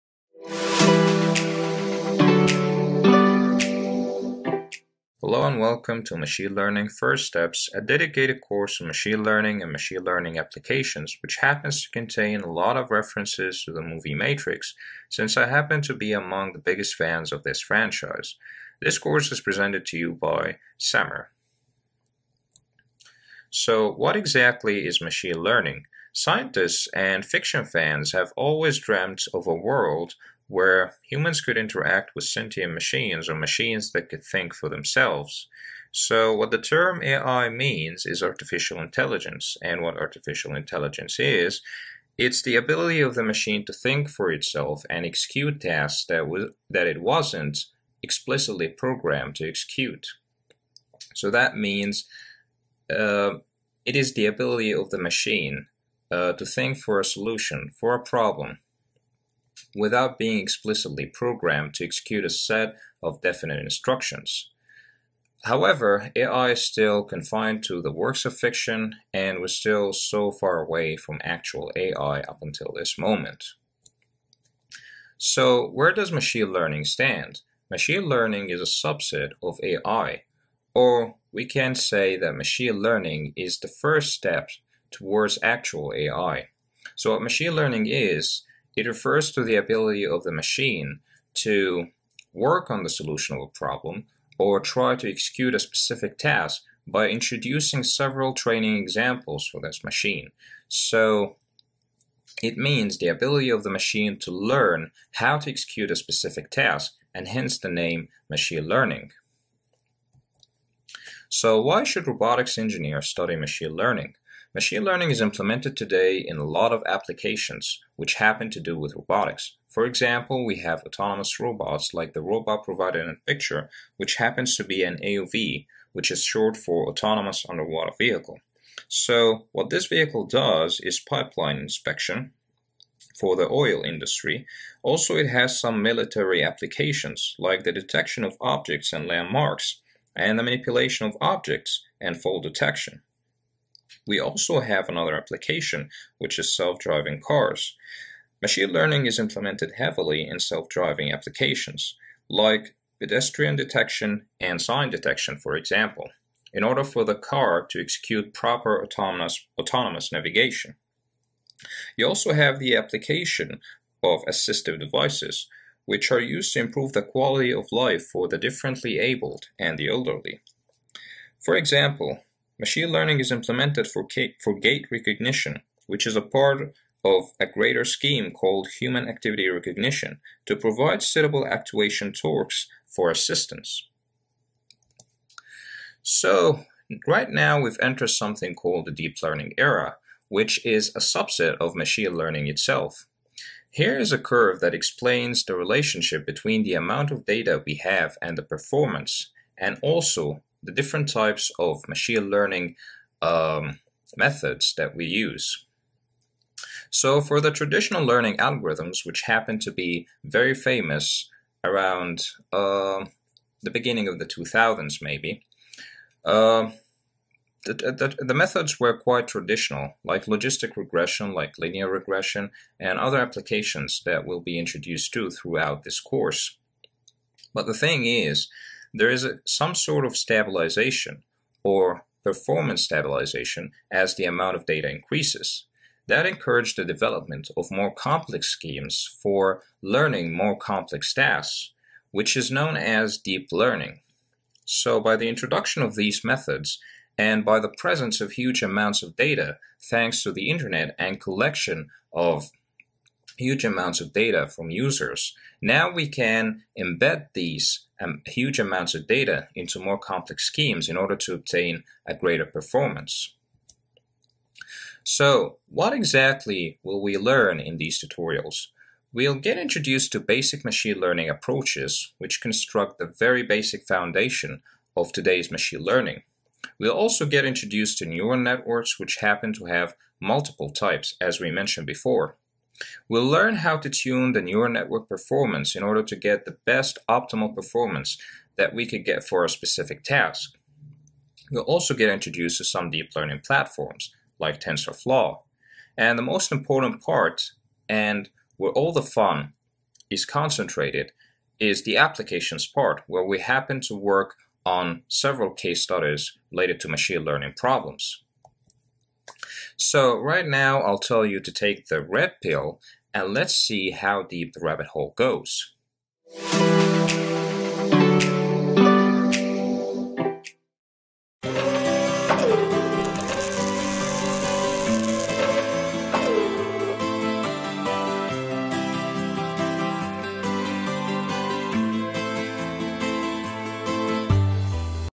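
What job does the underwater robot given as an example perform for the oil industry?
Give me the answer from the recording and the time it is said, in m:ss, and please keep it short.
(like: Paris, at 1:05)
pipeline inspection, at 2:10.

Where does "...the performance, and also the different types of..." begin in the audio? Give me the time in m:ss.
3:18.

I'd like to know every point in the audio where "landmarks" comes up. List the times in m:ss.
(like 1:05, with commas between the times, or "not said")
2:19.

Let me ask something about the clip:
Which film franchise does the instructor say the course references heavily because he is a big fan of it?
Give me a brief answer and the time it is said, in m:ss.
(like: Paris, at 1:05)
Matrix, at 0:14.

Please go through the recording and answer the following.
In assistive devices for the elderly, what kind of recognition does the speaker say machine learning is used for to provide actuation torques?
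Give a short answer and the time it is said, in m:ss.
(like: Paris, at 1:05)
gait recognition, at 2:54.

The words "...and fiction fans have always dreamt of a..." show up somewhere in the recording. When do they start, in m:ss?
0:26.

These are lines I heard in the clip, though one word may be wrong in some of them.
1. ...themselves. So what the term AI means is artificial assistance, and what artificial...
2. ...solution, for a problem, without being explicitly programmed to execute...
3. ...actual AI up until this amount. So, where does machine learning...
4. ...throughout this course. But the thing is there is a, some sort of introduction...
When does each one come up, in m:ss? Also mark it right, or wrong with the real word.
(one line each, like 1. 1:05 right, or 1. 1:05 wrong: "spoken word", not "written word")
1. 0:34 wrong: "intelligence", not "assistance"
2. 0:57 right
3. 1:11 wrong: "moment", not "amount"
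4. 3:45 wrong: "stabilization", not "introduction".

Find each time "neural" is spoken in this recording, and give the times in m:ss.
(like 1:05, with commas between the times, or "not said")
4:38, 4:44.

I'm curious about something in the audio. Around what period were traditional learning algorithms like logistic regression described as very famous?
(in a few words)
beginning of the 2000s.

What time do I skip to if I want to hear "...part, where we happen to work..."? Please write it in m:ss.
5:02.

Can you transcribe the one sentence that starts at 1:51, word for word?
So why should robotics engineers study machine learning?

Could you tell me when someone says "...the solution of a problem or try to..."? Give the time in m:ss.
1:32.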